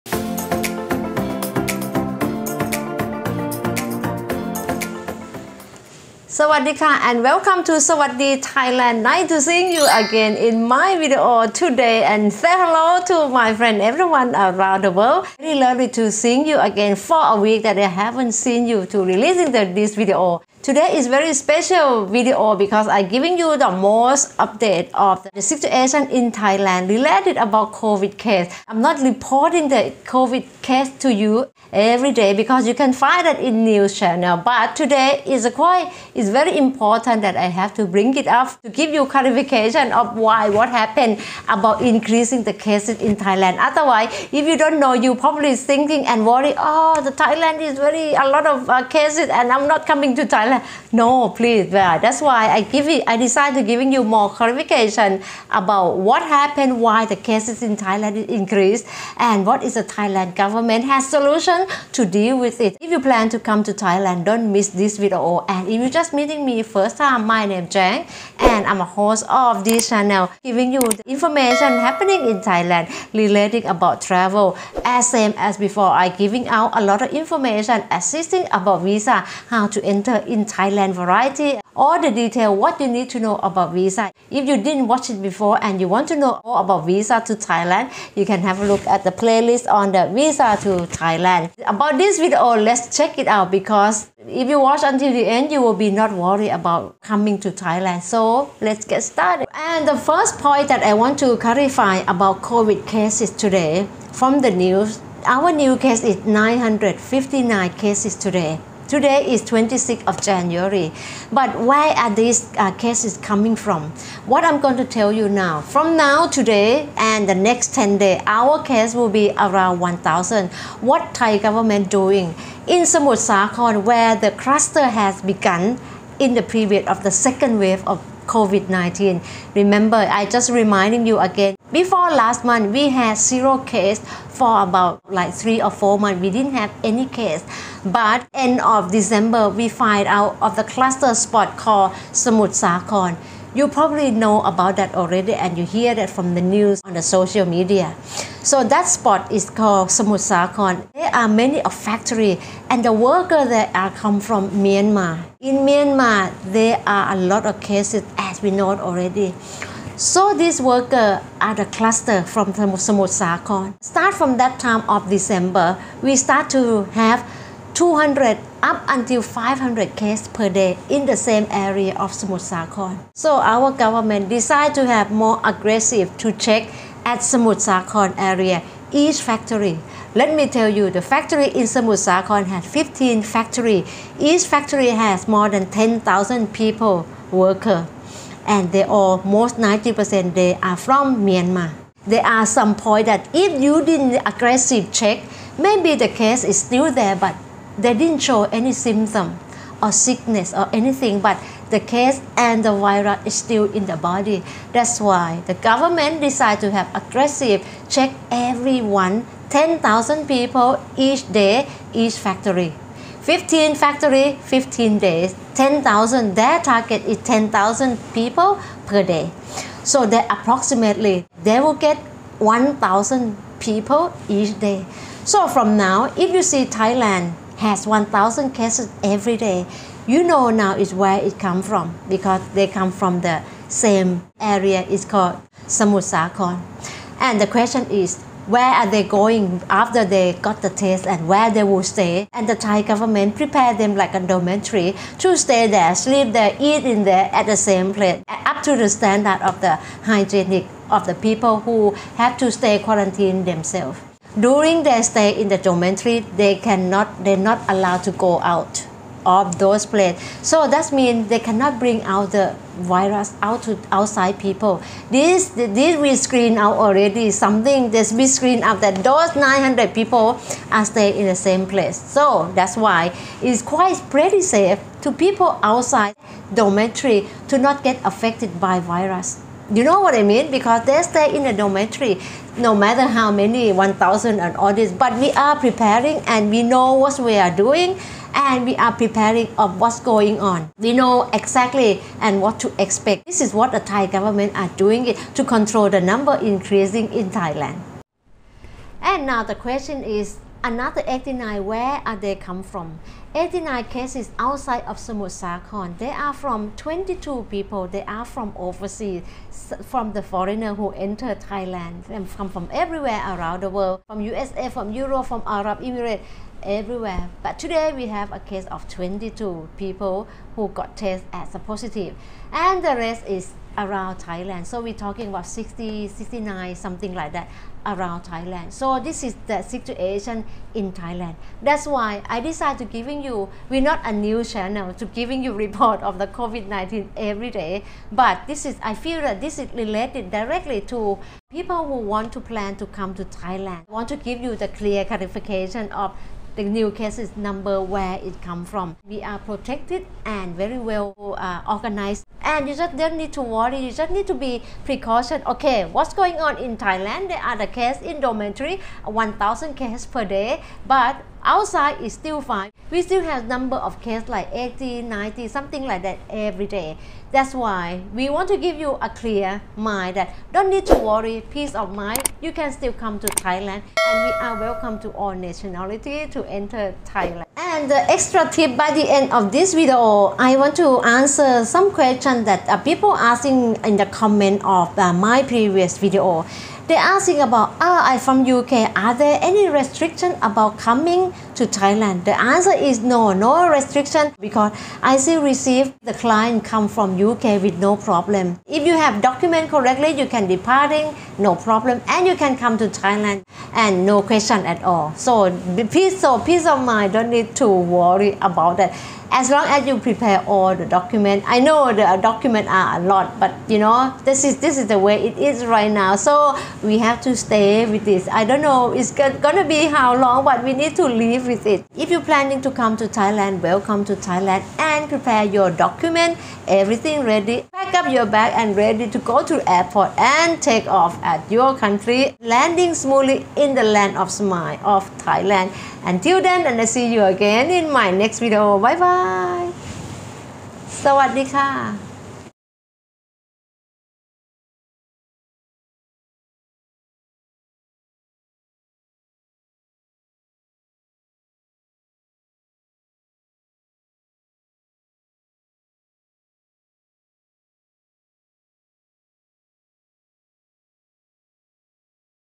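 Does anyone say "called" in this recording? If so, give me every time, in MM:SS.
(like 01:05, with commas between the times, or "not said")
02:21, 02:29, 03:55.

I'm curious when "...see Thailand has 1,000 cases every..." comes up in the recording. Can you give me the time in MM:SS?
03:46.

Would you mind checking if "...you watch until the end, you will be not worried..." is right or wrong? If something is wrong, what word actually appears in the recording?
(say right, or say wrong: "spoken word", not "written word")
right.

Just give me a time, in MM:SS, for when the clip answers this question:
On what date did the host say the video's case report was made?
01:49.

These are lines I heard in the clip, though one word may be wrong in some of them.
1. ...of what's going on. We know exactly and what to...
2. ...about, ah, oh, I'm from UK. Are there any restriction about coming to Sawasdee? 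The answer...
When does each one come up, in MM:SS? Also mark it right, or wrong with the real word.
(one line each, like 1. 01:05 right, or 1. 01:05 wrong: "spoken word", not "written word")
1. 04:49 right
2. 06:27 wrong: "Thailand", not "Sawasdee".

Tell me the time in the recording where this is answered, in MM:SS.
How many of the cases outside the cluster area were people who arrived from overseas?
05:05.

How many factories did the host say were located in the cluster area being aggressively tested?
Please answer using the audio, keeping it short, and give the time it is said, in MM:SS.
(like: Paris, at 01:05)
15, at 03:02.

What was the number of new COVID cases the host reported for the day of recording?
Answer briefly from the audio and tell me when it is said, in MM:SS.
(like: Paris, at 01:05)
959, at 01:46.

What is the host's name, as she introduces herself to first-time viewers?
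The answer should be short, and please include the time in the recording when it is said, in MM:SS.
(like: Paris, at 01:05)
Jang, at 01:07.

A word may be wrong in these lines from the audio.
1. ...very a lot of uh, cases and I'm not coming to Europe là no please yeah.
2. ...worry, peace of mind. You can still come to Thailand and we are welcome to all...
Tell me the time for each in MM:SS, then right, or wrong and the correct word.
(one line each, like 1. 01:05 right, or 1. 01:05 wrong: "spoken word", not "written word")
1. 00:47 wrong: "Thailand", not "Europe"
2. 06:10 right.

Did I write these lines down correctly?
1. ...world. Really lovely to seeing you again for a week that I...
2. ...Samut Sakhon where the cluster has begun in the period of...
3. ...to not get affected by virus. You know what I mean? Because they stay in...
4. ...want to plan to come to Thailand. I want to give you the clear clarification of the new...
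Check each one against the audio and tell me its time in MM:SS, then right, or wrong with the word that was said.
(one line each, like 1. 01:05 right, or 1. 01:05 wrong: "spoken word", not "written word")
1. 00:14 right
2. 02:02 right
3. 04:37 right
4. 05:41 right.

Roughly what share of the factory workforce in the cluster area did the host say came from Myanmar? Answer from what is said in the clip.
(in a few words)
90%.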